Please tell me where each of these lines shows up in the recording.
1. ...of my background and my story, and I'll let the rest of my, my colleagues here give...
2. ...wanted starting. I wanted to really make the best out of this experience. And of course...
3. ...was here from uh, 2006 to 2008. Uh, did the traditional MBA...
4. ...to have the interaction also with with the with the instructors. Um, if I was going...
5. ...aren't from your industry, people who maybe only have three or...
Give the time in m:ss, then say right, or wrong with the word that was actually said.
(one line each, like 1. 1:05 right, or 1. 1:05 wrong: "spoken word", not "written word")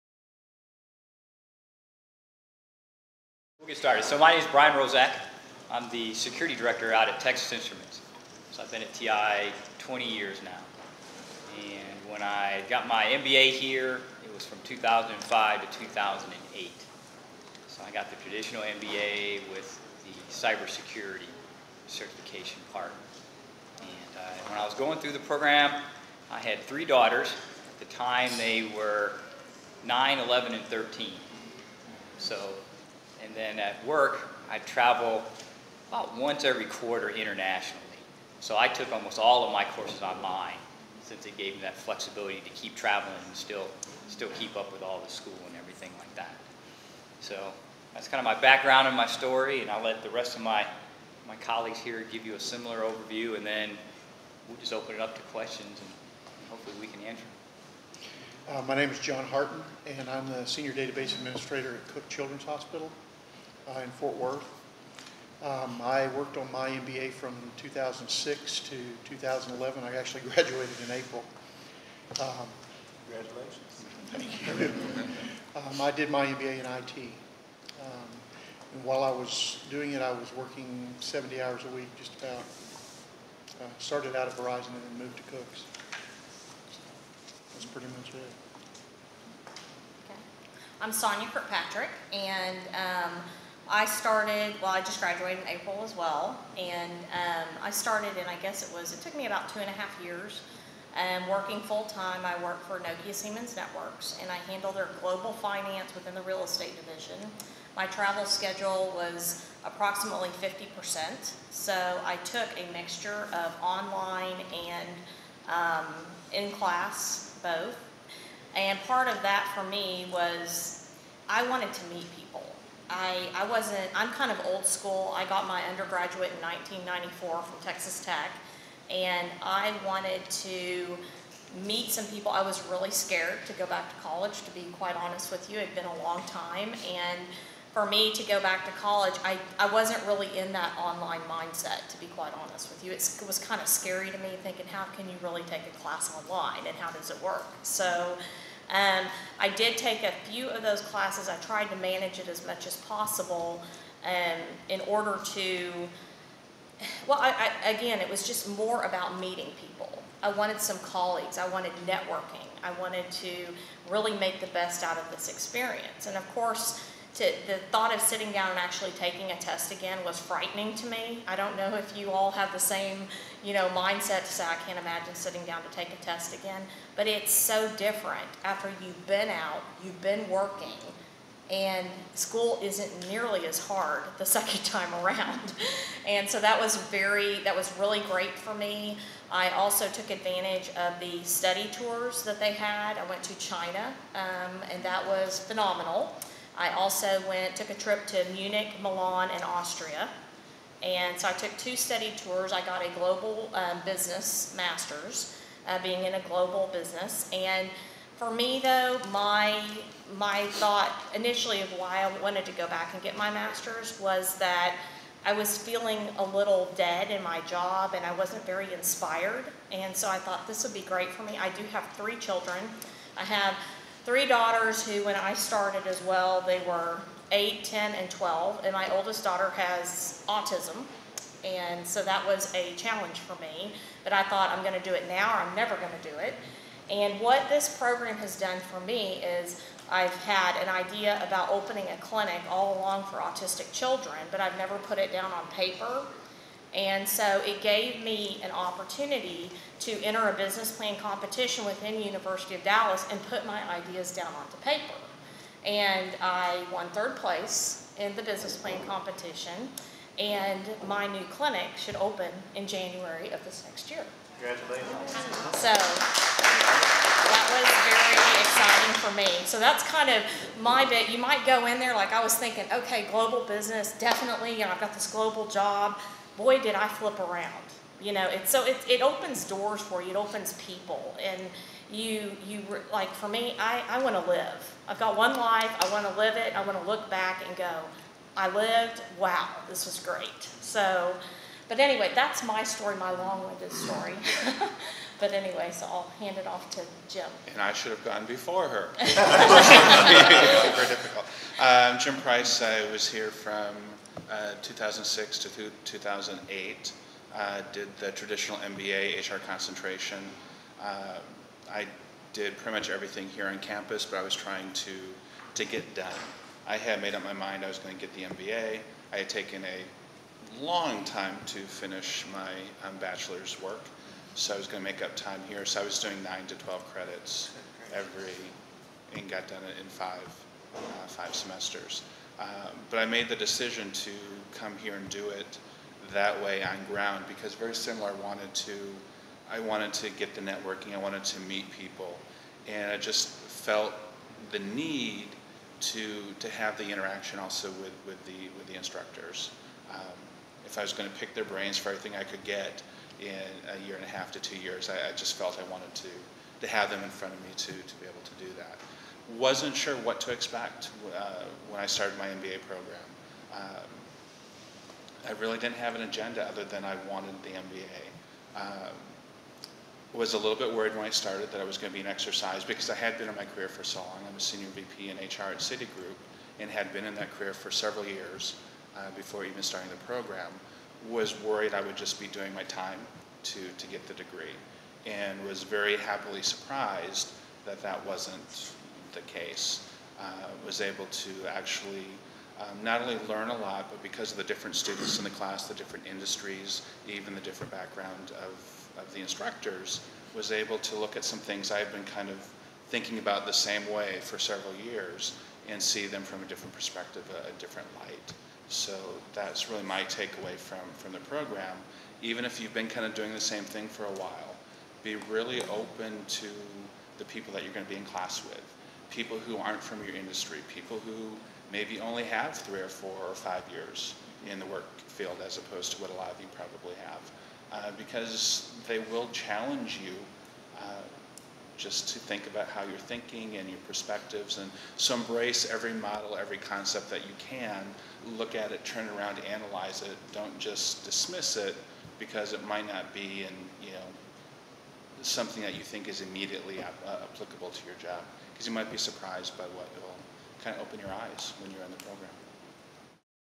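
1. 0:48 right
2. 2:41 wrong: "networking", not "starting"
3. 5:02 right
4. 5:46 right
5. 6:59 right.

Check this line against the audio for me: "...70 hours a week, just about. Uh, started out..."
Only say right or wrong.
right.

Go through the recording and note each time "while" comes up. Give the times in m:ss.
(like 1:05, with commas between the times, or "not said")
1:18, 6:54.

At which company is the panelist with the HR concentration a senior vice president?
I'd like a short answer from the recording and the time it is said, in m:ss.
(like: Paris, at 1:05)
Citigroup, at 6:15.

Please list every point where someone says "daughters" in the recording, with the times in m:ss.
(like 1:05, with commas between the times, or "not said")
0:26, 3:44, 3:49.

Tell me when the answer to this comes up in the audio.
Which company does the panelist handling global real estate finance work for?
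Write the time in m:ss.
1:42.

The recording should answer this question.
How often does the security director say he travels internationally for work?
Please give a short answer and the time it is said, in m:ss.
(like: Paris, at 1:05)
once every quarter, at 0:36.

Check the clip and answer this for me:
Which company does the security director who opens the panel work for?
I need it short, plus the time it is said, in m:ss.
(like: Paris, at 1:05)
Texas Instruments, at 0:07.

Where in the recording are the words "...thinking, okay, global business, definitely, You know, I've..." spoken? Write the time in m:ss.
4:32.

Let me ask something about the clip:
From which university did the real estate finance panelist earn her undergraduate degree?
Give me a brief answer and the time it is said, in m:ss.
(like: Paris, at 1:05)
Texas Tech, at 2:07.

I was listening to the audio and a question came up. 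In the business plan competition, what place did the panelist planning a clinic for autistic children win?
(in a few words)
third place.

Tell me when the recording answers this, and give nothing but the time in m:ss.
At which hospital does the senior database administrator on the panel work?
1:01.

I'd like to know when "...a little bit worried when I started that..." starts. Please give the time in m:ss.
6:10.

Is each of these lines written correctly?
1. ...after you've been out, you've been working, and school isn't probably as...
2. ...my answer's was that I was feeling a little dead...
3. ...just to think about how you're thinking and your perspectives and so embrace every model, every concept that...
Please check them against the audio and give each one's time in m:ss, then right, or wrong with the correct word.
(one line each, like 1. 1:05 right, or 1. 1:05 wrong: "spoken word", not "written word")
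1. 2:58 wrong: "nearly", not "probably"
2. 3:33 wrong: "master", not "answer"
3. 7:11 right.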